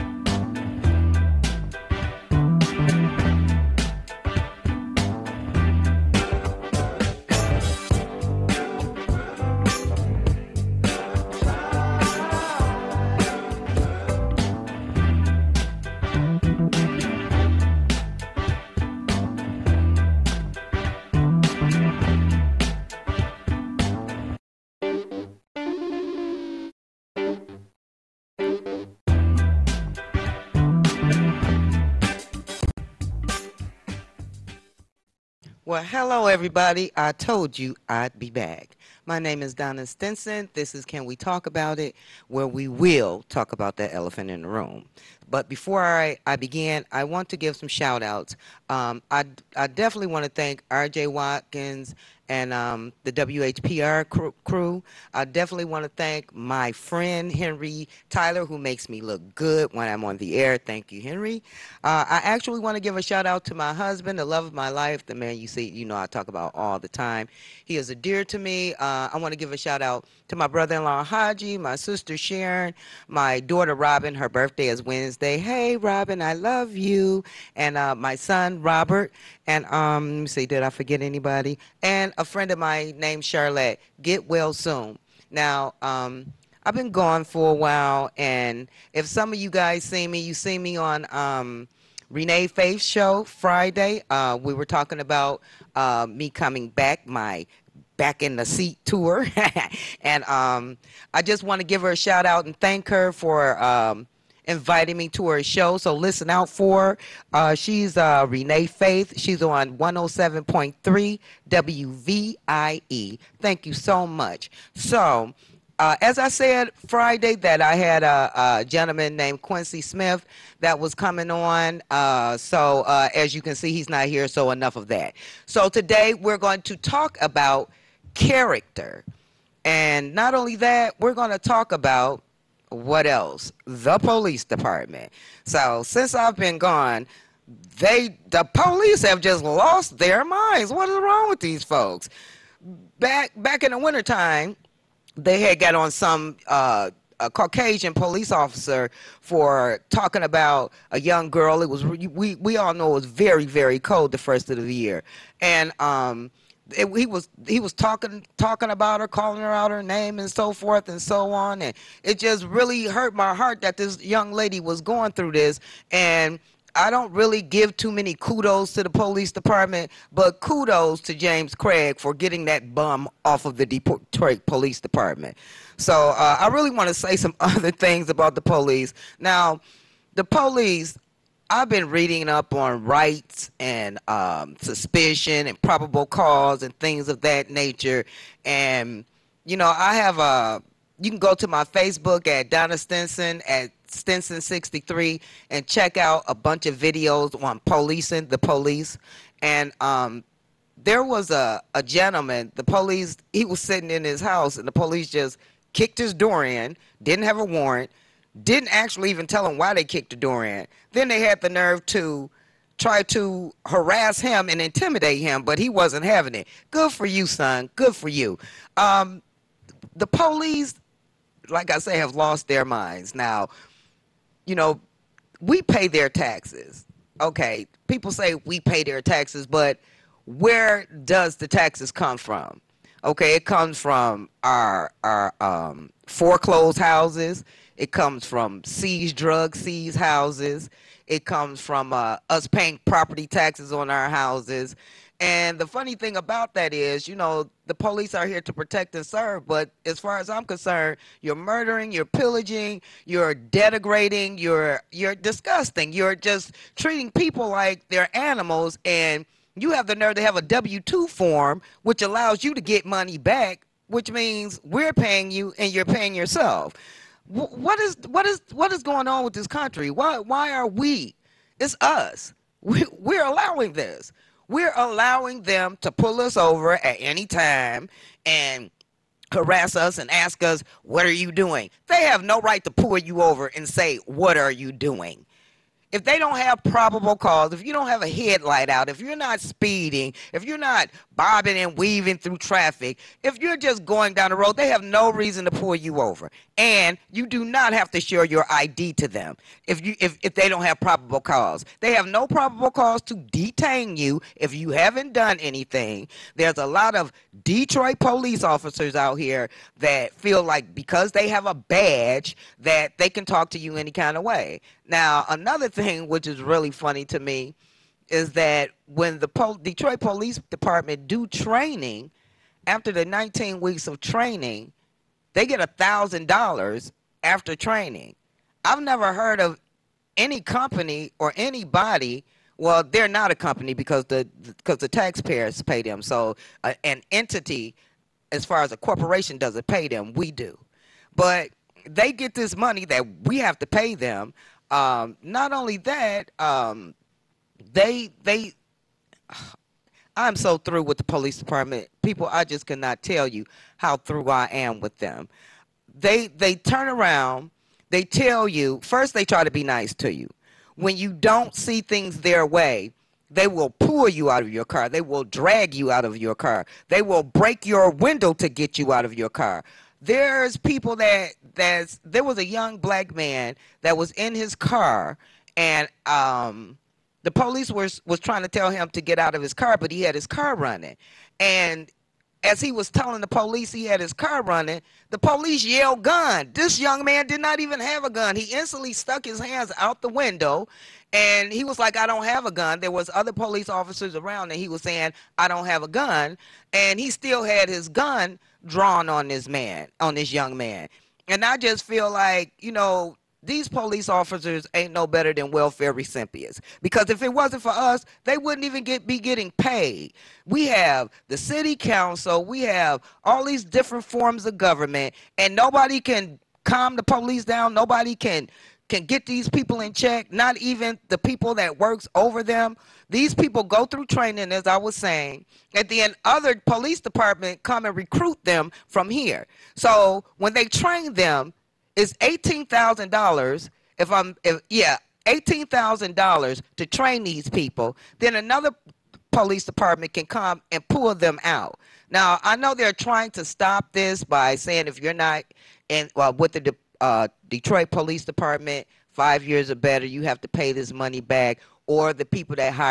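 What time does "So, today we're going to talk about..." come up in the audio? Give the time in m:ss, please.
2:05.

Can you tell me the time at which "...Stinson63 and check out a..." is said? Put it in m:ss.
3:13.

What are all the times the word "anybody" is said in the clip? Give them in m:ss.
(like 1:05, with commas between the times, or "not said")
1:21, 5:31.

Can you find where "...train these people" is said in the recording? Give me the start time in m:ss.
7:16.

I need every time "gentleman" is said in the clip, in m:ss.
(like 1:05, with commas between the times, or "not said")
1:58, 3:21.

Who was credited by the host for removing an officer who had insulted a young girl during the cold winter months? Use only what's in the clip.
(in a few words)
James Craig.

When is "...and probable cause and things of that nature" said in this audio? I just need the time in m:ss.
3:05.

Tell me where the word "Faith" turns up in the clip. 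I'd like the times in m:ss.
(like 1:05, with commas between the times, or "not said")
1:32, 1:48.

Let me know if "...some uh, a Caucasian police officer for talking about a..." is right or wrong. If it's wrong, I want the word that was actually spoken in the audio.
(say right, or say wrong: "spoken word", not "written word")
right.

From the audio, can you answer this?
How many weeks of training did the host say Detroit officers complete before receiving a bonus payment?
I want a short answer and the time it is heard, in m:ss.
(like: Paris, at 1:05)
19, at 5:23.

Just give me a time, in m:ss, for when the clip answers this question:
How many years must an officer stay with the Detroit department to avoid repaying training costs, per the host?
7:29.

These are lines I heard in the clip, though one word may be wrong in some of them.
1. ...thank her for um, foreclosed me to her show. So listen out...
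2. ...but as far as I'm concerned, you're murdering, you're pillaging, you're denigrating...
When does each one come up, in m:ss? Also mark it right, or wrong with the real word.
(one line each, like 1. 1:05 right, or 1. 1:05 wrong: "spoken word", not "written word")
1. 1:42 wrong: "invited", not "foreclosed"
2. 4:09 right.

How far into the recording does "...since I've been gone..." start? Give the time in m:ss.
2:15.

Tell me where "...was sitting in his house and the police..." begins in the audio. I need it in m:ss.
3:23.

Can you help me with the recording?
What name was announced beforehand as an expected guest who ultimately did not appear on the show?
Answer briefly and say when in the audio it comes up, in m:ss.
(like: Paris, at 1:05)
Quincy Smith, at 1:59.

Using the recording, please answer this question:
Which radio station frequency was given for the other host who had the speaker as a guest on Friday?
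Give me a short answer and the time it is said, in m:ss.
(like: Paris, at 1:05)
107.3 WVIE, at 1:49.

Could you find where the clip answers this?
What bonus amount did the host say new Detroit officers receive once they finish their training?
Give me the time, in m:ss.
5:25.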